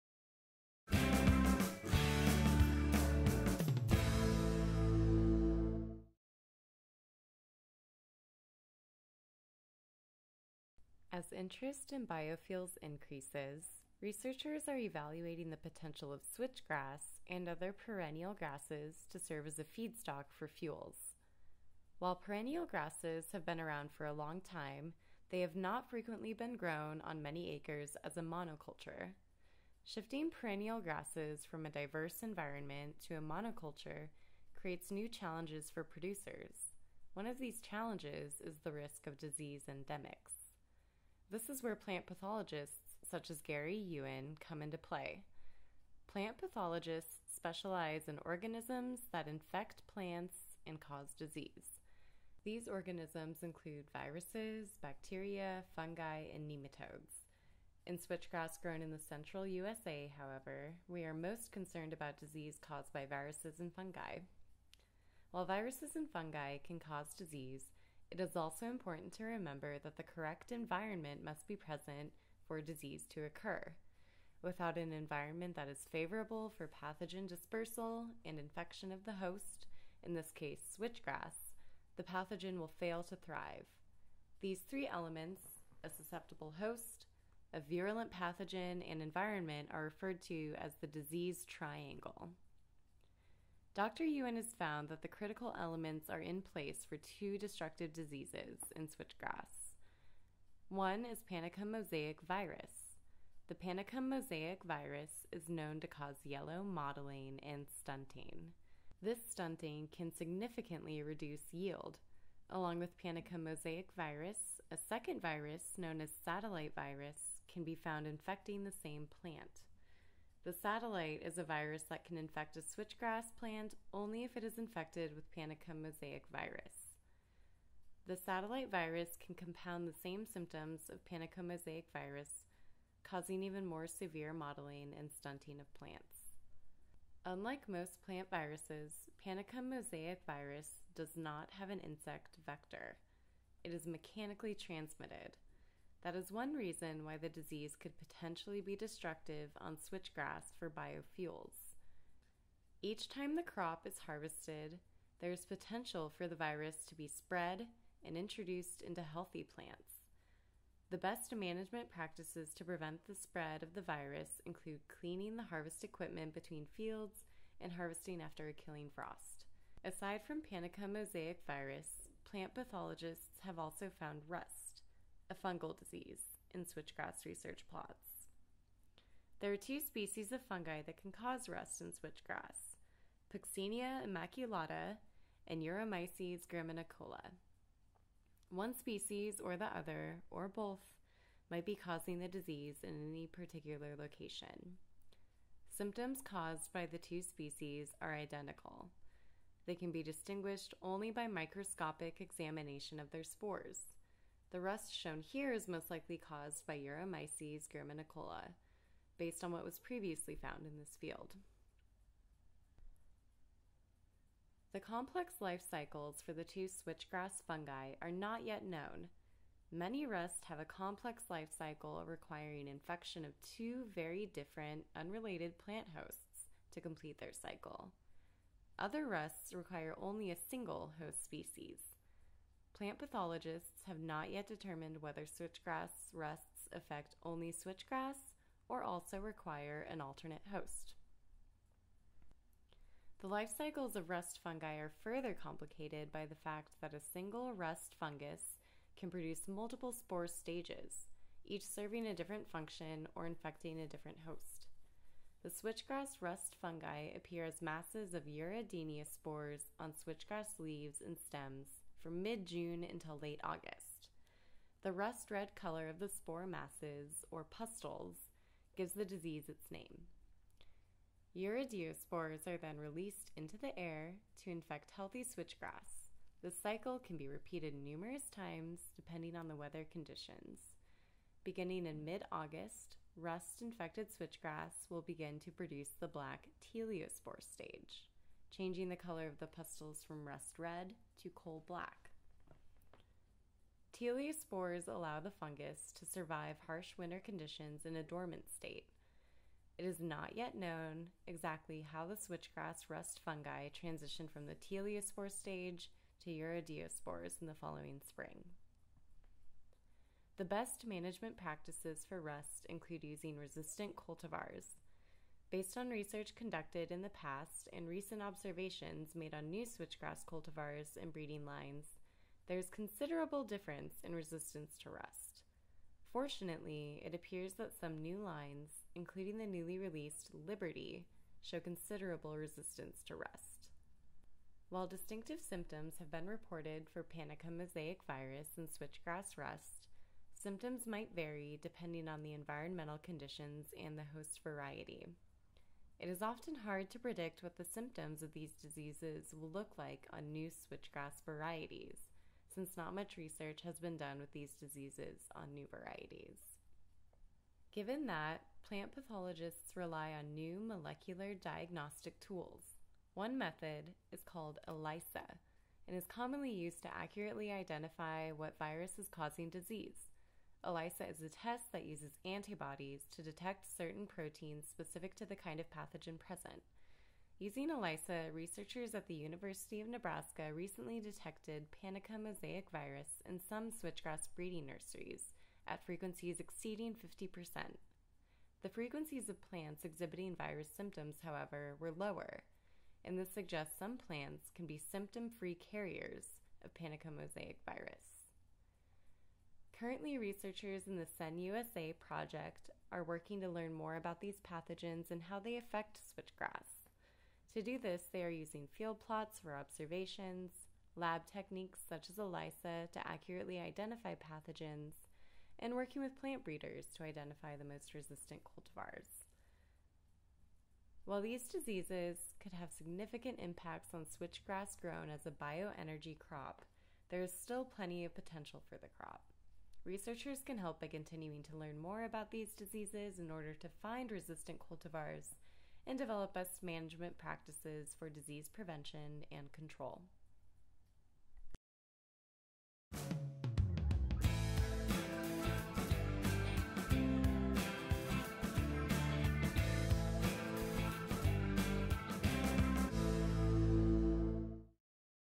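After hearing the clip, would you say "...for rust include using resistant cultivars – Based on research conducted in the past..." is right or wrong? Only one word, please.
right.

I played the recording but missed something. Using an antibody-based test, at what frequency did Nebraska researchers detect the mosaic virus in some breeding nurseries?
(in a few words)
exceeding 50%.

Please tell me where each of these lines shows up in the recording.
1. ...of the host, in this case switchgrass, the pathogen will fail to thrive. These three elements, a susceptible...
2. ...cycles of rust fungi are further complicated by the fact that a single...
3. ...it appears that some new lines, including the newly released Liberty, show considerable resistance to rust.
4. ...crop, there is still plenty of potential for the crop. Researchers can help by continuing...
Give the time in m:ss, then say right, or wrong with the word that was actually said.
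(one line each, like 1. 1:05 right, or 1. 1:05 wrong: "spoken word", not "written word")
1. 1:18 right
2. 4:03 right
3. 5:27 right
4. 7:06 right.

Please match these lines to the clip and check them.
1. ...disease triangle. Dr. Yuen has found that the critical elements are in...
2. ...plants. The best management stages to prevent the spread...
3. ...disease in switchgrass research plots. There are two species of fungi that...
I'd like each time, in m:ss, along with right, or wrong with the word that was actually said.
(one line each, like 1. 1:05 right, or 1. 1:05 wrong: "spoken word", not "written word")
1. 1:30 right
2. 2:39 wrong: "practices", not "stages"
3. 2:55 right.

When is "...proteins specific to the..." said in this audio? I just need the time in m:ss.
6:14.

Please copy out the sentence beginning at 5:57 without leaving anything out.
Given that, plant pathologists rely on new molecular diagnostic tools.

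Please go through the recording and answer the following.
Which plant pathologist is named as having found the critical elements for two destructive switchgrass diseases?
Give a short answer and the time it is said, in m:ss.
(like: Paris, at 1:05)
Gary Yuen, at 0:43.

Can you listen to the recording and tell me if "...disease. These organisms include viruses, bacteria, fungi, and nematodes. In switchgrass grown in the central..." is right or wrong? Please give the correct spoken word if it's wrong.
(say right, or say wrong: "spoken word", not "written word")
right.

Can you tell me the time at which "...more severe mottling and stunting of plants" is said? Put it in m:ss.
2:13.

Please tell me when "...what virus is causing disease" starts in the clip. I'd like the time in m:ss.
6:08.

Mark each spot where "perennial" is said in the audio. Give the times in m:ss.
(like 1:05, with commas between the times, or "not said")
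0:17, 0:22, 0:30.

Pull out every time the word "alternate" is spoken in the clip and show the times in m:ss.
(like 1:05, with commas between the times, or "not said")
4:00.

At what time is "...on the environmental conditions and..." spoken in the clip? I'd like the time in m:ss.
5:42.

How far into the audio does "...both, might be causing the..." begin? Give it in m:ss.
3:10.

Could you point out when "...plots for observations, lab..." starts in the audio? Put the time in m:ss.
6:48.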